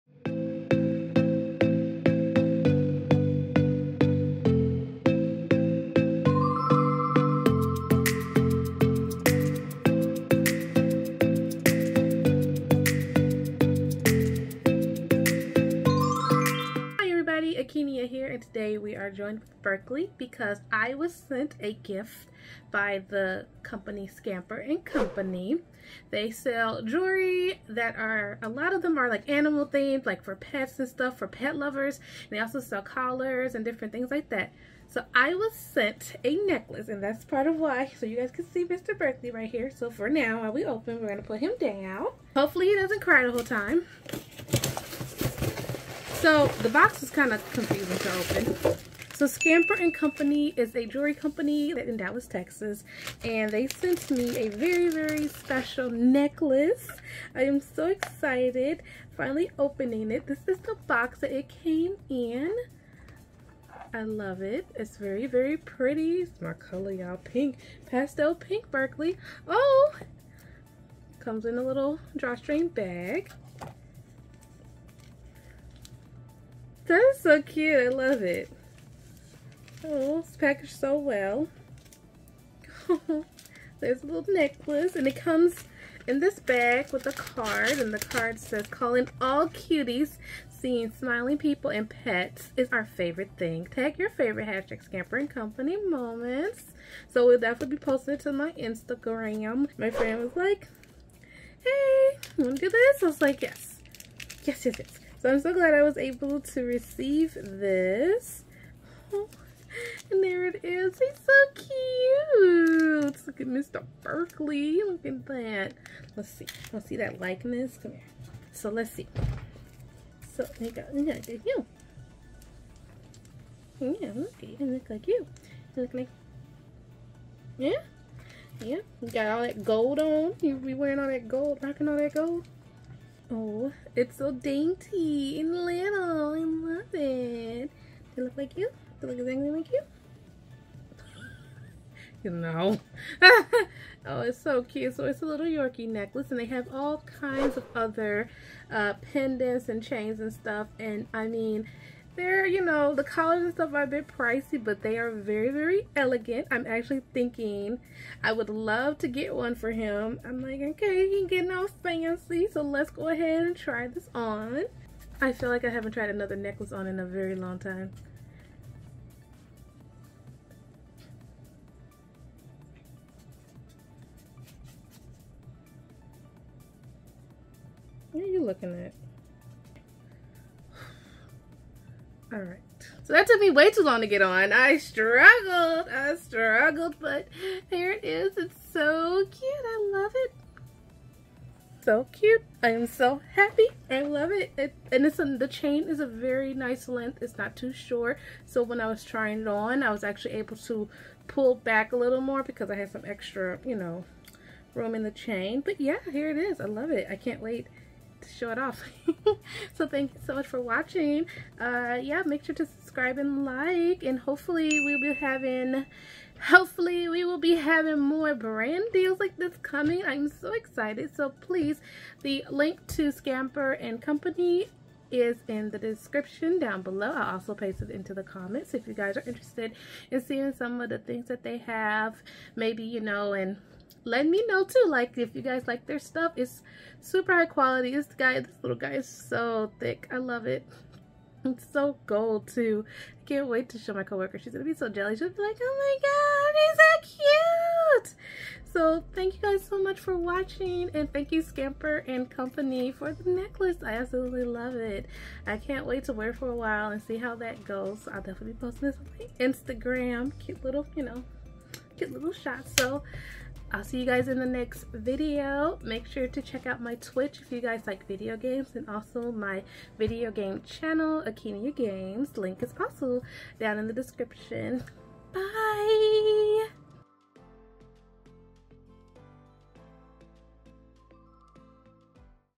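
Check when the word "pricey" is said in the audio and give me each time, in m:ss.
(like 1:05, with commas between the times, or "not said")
2:34.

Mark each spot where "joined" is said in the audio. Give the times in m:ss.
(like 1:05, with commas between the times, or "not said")
0:19.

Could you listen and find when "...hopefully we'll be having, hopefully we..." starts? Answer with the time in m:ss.
3:34.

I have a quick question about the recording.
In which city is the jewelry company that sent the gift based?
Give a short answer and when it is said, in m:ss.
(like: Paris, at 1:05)
Dallas, Texas, at 0:51.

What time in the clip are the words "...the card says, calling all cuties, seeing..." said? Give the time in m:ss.
1:27.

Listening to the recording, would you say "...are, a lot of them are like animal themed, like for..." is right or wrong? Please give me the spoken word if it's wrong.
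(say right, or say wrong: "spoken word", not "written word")
right.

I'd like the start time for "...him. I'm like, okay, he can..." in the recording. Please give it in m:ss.
2:39.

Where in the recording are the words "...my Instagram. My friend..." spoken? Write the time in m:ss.
1:38.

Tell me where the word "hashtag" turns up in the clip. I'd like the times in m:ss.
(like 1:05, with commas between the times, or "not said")
1:34.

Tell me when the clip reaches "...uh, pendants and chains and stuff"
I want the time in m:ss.
2:28.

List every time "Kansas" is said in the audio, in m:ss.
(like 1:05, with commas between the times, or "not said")
not said.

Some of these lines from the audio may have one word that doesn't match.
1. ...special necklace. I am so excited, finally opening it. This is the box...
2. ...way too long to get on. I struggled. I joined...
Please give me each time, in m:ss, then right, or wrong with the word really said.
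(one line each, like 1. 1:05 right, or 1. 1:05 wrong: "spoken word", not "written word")
1. 0:55 right
2. 3:03 wrong: "struggled", not "joined".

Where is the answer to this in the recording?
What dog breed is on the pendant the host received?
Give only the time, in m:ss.
2:25.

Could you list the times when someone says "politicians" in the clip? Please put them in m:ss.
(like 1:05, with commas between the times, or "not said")
not said.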